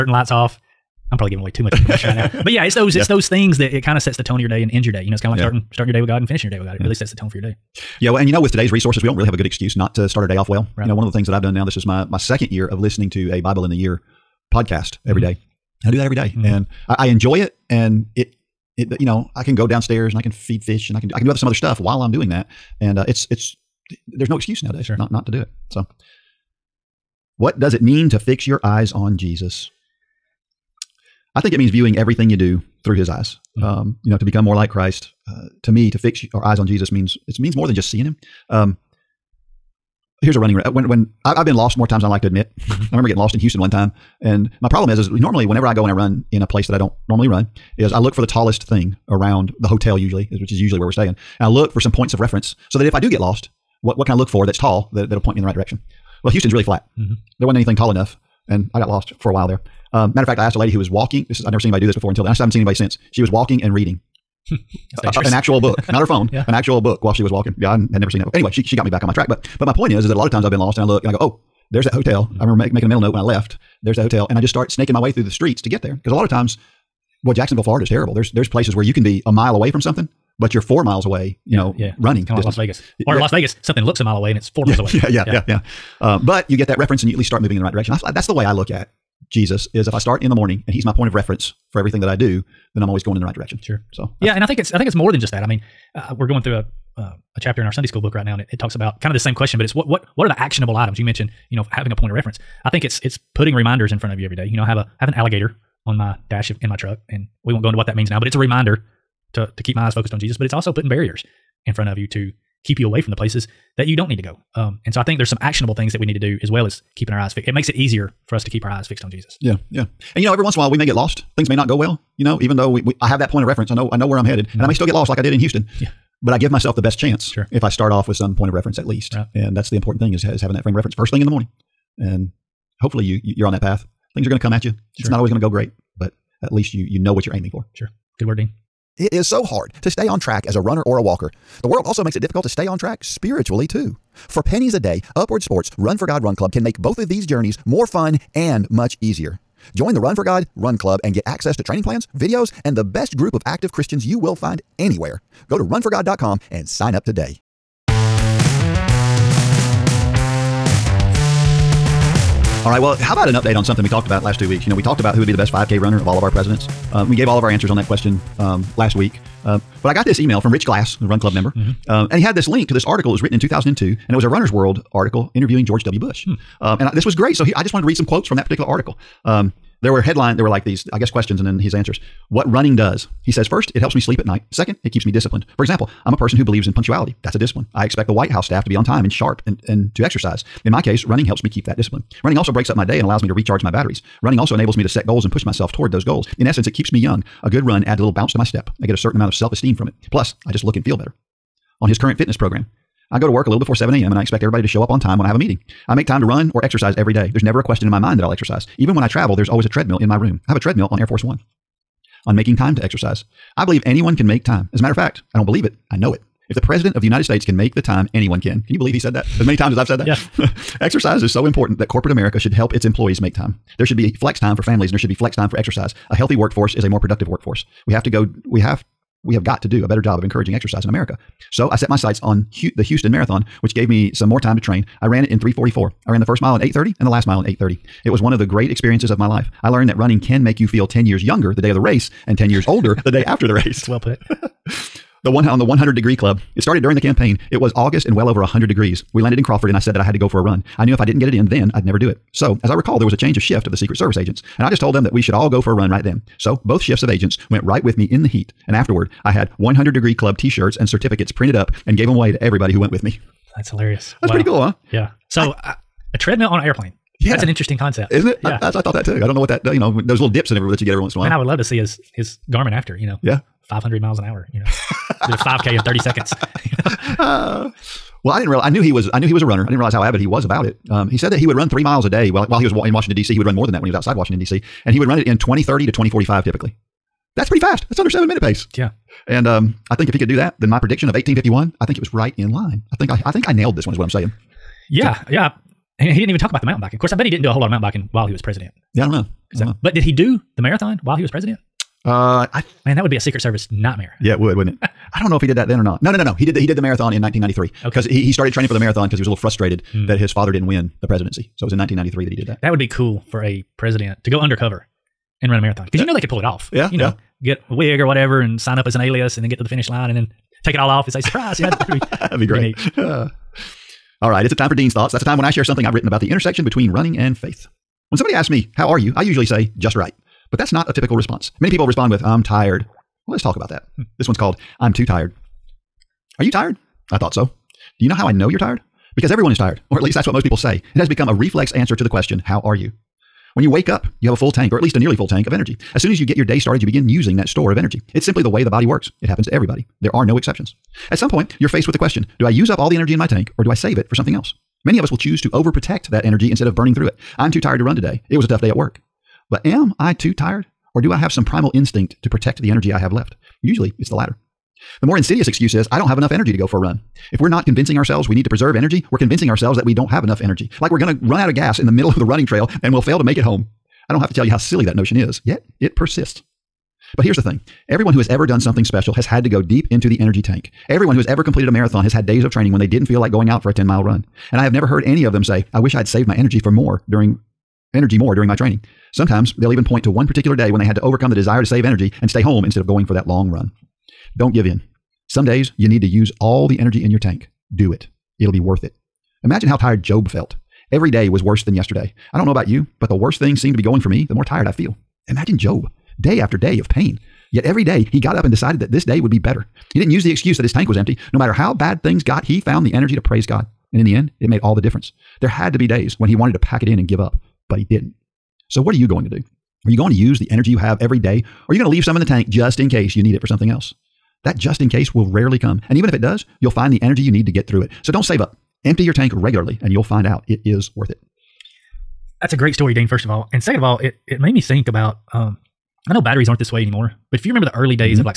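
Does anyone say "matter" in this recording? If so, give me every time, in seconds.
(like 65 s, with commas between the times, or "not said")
60 s, 214 s, 411 s.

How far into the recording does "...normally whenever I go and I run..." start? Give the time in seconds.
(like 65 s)
45 s.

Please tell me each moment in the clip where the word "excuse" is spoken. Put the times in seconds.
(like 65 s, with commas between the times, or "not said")
9 s, 24 s, 365 s, 410 s.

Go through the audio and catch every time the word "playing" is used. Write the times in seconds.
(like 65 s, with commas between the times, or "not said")
not said.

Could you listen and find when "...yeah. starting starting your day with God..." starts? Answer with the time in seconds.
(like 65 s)
5 s.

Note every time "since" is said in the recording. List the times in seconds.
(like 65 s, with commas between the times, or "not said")
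62 s.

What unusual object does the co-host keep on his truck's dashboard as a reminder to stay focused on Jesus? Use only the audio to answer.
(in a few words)
An alligator.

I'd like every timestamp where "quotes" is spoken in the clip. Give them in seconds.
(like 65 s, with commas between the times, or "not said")
178 s.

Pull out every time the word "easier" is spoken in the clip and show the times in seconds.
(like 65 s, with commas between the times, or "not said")
117 s, 149 s.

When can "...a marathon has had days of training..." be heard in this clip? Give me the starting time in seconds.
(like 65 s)
381 s.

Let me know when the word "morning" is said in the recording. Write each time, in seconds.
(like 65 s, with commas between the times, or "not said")
90 s, 131 s.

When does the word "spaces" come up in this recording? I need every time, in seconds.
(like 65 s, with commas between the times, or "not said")
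not said.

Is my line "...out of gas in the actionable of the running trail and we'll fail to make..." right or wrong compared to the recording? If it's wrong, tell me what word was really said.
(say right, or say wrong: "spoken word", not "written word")
wrong: "middle", not "actionable".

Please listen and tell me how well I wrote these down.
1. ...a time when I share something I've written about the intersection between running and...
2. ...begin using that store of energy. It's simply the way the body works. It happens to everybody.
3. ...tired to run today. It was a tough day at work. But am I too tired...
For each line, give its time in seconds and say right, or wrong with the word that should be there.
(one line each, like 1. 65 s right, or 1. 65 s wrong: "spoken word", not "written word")
1. 325 s right
2. 346 s right
3. 357 s right.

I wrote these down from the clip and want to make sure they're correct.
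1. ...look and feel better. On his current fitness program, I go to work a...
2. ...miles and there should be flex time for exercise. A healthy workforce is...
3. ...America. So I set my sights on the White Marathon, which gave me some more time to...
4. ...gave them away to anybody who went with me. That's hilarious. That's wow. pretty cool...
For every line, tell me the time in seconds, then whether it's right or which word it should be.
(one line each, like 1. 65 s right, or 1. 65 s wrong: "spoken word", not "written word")
1. 200 s right
2. 224 s wrong: "families", not "miles"
3. 230 s wrong: "Houston", not "White"
4. 261 s wrong: "everybody", not "anybody".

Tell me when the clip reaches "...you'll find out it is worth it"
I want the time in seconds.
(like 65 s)
429 s.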